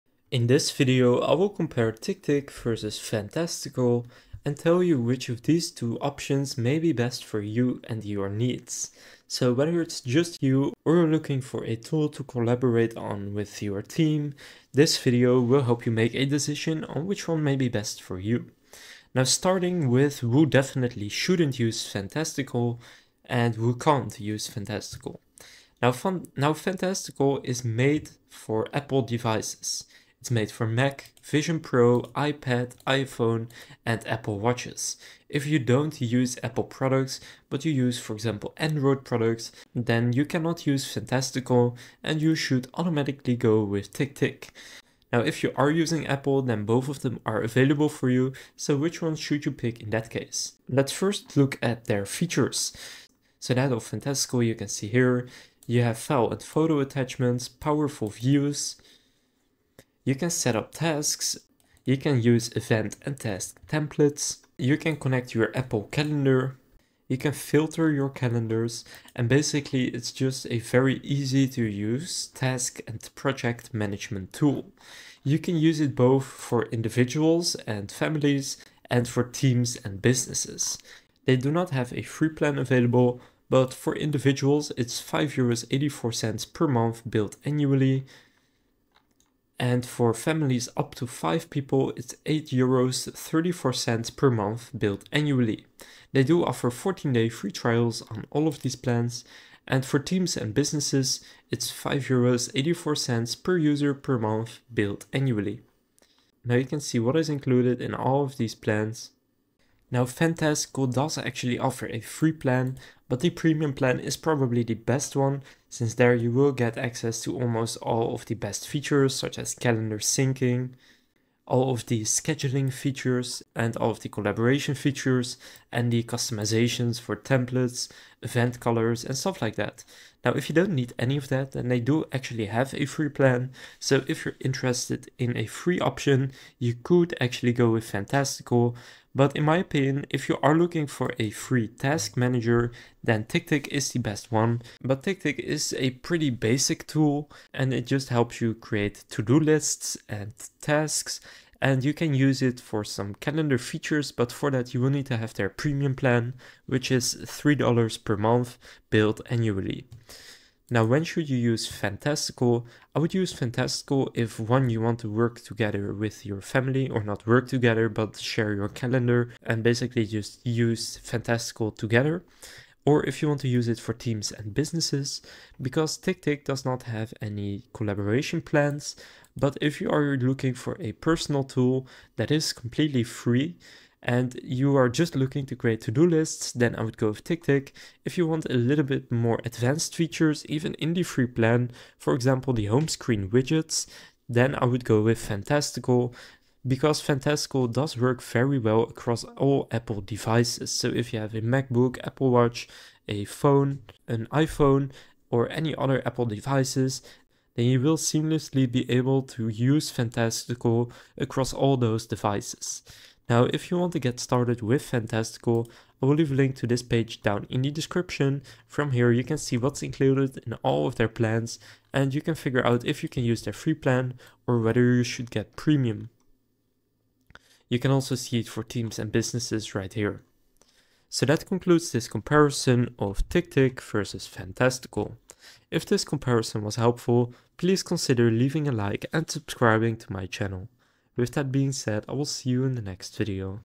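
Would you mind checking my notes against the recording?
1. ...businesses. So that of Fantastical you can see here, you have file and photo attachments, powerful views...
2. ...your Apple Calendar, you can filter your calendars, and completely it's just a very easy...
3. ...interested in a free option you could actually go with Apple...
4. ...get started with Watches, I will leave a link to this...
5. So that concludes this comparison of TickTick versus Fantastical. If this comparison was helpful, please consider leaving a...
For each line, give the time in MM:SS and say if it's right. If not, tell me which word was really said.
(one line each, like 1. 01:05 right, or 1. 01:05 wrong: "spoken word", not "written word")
1. 00:52 wrong: "features", not "businesses"
2. 01:05 wrong: "basically", not "completely"
3. 02:14 wrong: "Fantastical", not "Apple"
4. 03:33 wrong: "Fantastical", not "Watches"
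5. 03:51 right.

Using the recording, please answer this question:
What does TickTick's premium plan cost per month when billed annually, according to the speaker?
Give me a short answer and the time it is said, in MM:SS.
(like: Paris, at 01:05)
$3, at 02:37.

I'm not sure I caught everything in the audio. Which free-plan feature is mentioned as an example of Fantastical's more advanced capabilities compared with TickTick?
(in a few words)
home screen widgets.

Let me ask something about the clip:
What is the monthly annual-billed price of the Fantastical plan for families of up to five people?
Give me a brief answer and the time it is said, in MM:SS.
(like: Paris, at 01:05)
8.34 euros, at 01:32.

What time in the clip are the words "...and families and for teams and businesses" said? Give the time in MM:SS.
01:17.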